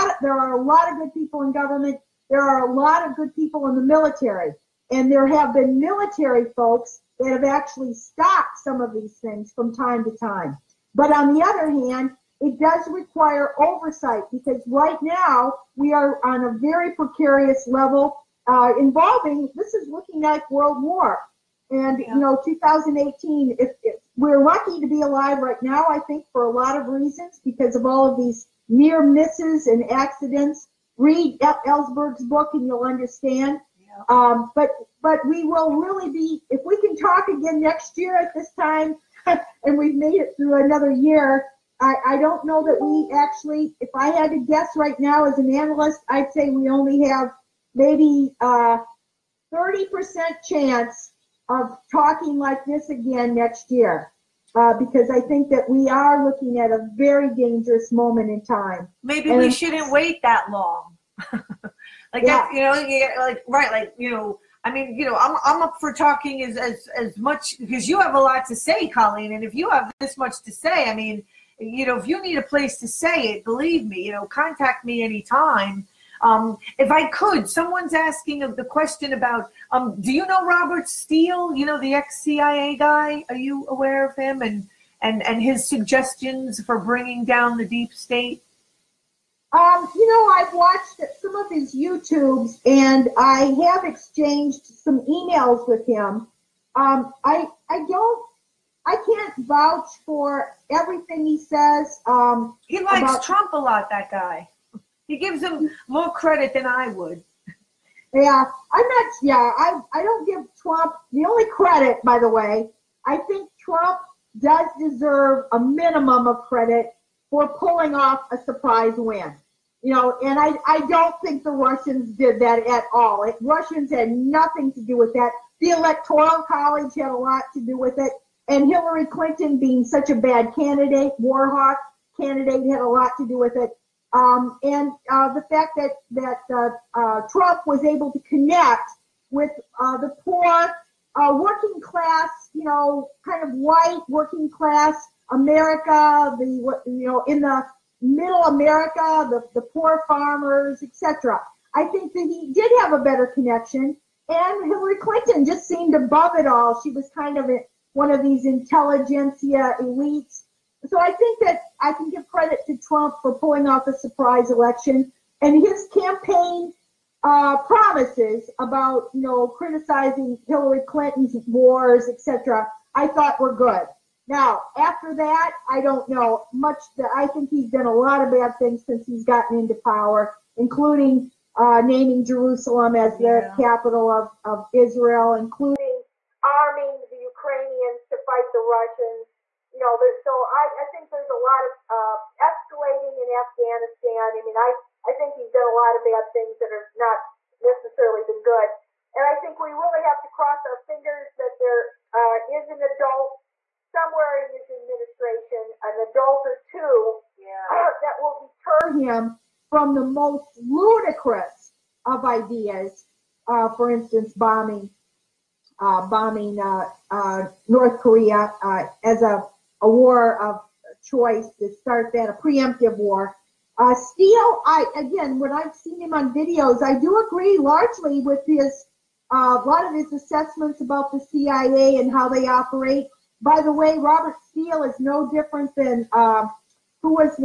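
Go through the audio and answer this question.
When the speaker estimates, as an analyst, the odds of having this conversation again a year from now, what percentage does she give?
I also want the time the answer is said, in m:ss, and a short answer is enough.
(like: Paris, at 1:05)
30%, at 0:49.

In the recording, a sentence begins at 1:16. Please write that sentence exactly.
Um, if I could, someone's asking the question about, um, do you know Robert Steele?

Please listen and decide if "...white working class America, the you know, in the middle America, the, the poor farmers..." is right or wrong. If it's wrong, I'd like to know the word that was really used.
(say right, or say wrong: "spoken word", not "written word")
right.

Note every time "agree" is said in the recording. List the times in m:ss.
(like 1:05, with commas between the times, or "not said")
3:47.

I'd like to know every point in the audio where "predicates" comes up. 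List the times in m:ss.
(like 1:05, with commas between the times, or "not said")
not said.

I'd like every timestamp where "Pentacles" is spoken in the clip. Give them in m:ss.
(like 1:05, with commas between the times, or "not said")
not said.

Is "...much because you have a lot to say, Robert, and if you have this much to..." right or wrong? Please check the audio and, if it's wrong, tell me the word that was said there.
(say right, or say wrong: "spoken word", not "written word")
wrong: "Coleen", not "Robert".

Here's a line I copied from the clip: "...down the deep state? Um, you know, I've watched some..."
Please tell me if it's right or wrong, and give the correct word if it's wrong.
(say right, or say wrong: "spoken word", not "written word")
right.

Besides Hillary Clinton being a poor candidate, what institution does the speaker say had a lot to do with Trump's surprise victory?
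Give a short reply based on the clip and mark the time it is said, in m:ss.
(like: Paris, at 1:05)
The Electoral College, at 2:05.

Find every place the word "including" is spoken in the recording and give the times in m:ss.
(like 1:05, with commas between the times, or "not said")
3:00, 3:05.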